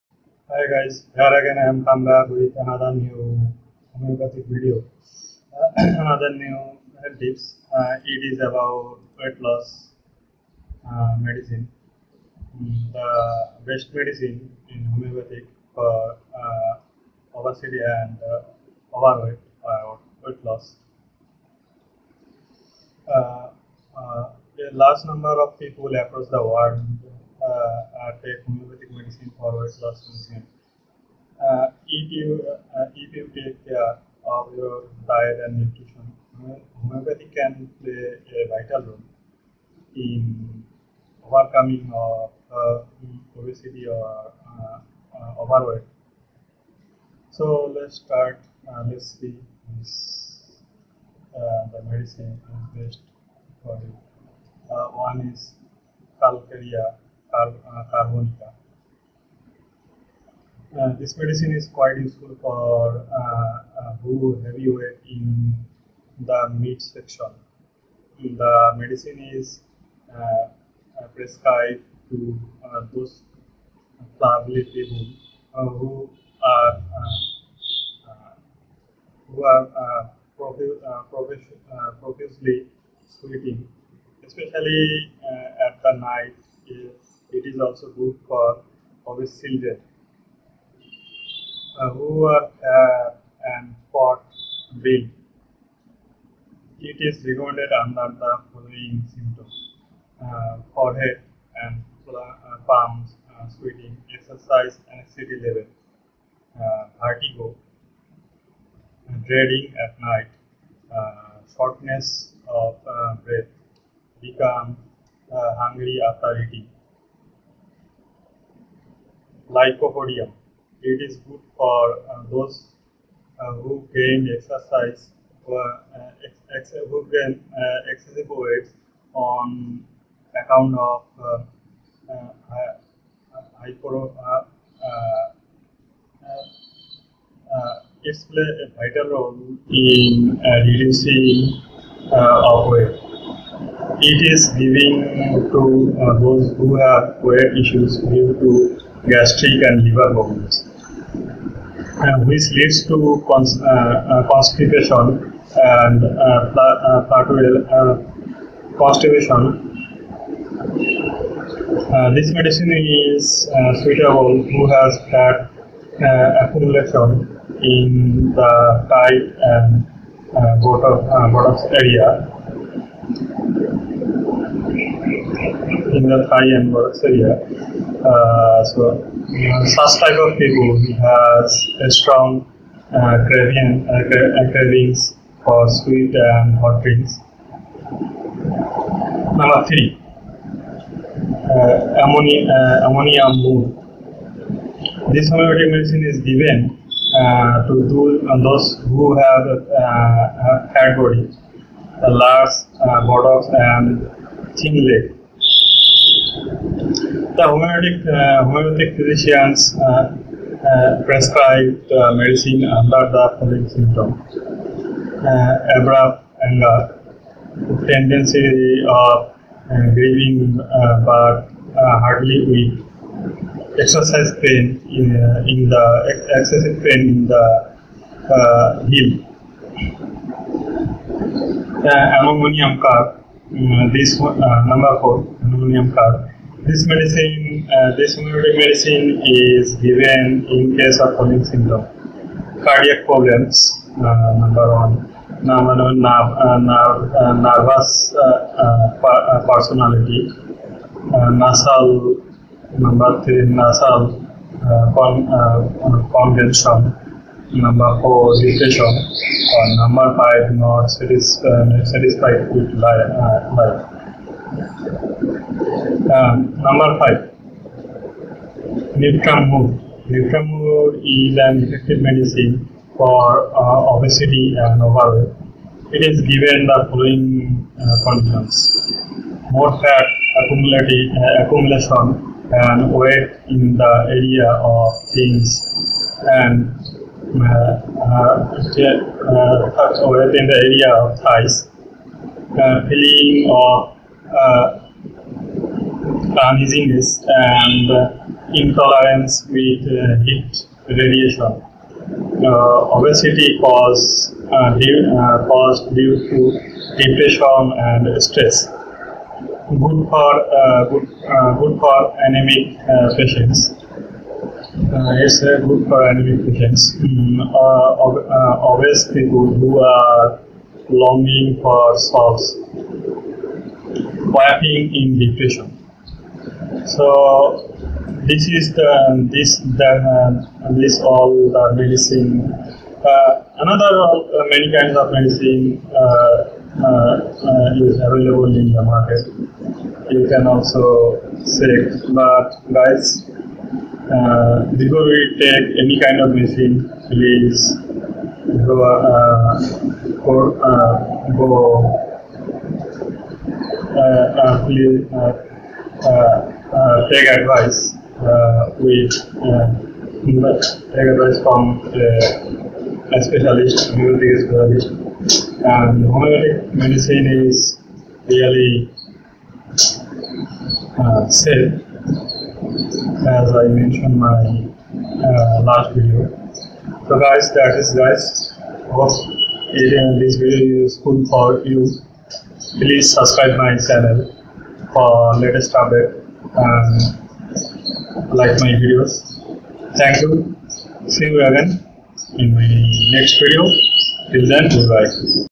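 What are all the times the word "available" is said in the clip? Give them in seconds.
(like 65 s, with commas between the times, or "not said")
338 s.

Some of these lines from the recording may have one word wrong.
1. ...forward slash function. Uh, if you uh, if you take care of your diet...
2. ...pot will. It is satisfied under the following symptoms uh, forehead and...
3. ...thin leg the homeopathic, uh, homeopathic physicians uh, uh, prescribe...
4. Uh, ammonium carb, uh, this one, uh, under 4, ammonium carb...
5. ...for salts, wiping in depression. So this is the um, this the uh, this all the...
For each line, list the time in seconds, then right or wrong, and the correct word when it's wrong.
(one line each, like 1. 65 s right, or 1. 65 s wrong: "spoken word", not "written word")
1. 29 s right
2. 93 s wrong: "recorded", not "satisfied"
3. 204 s right
4. 231 s wrong: "number", not "under"
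5. 321 s right.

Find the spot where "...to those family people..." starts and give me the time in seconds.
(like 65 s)
72 s.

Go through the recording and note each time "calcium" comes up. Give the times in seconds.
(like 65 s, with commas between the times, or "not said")
56 s.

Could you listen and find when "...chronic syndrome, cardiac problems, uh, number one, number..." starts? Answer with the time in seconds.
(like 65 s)
241 s.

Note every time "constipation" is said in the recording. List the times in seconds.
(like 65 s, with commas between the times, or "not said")
154 s, 158 s.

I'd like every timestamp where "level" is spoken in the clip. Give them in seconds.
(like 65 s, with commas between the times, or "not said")
105 s.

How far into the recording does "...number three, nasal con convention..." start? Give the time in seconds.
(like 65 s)
252 s.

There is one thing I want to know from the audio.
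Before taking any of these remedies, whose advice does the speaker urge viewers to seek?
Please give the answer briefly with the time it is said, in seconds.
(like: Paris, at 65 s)
Homeopathic specialist, at 363 s.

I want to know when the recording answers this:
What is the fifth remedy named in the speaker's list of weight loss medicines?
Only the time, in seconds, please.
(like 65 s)
268 s.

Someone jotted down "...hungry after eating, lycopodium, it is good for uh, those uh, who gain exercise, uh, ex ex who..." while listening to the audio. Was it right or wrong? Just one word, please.
right.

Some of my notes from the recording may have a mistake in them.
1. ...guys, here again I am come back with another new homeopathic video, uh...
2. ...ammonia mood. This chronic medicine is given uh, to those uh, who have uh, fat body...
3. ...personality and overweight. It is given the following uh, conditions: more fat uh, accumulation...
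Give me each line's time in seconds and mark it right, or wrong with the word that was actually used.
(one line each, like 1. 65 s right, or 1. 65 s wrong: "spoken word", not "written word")
1. 0 s right
2. 192 s wrong: "homeopathic", not "chronic"
3. 273 s wrong: "obesity", not "personality".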